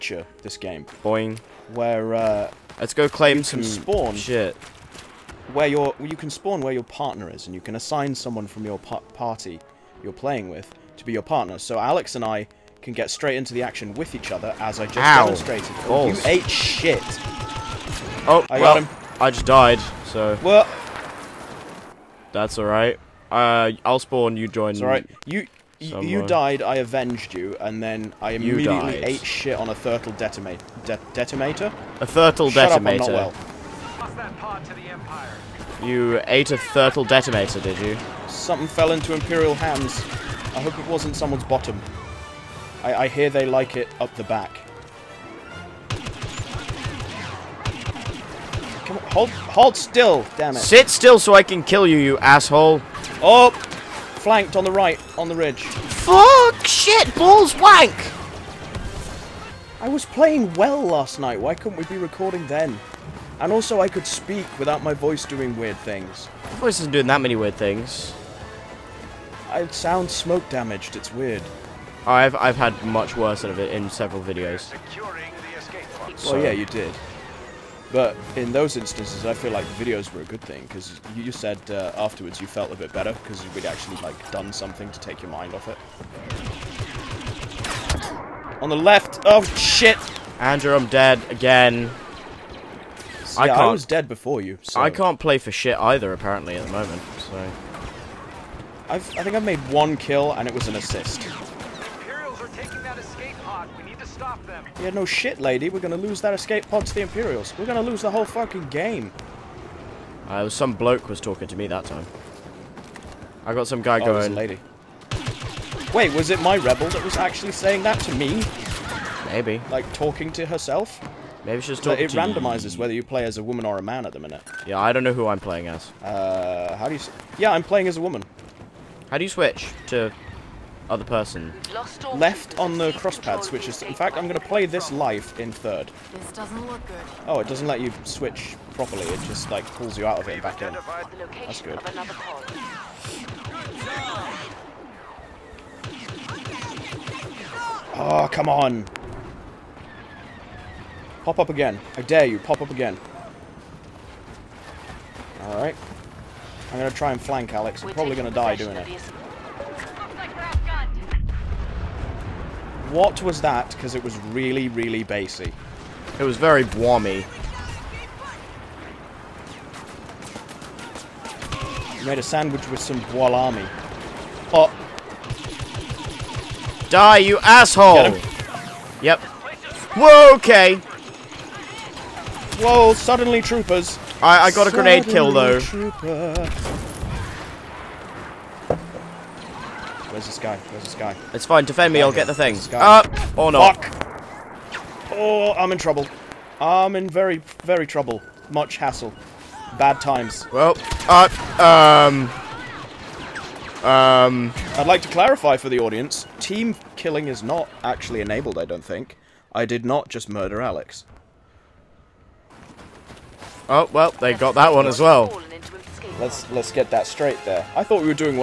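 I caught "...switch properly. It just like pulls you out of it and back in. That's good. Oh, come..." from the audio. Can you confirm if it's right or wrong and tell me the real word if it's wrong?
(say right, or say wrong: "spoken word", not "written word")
right.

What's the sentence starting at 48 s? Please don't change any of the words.
Come on, hold, hold still, damn it.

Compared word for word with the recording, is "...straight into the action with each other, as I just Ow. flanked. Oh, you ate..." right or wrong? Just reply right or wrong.
wrong.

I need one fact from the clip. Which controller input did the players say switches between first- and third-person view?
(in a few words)
Left on the crosspad.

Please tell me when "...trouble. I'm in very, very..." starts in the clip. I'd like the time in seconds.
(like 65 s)
195 s.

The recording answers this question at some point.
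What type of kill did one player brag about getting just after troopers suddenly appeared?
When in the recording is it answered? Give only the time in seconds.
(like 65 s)
184 s.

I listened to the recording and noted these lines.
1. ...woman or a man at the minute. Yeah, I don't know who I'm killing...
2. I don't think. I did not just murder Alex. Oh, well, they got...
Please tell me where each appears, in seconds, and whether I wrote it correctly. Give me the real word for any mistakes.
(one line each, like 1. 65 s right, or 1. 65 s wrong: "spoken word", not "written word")
1. 123 s wrong: "playing", not "killing"
2. 208 s right.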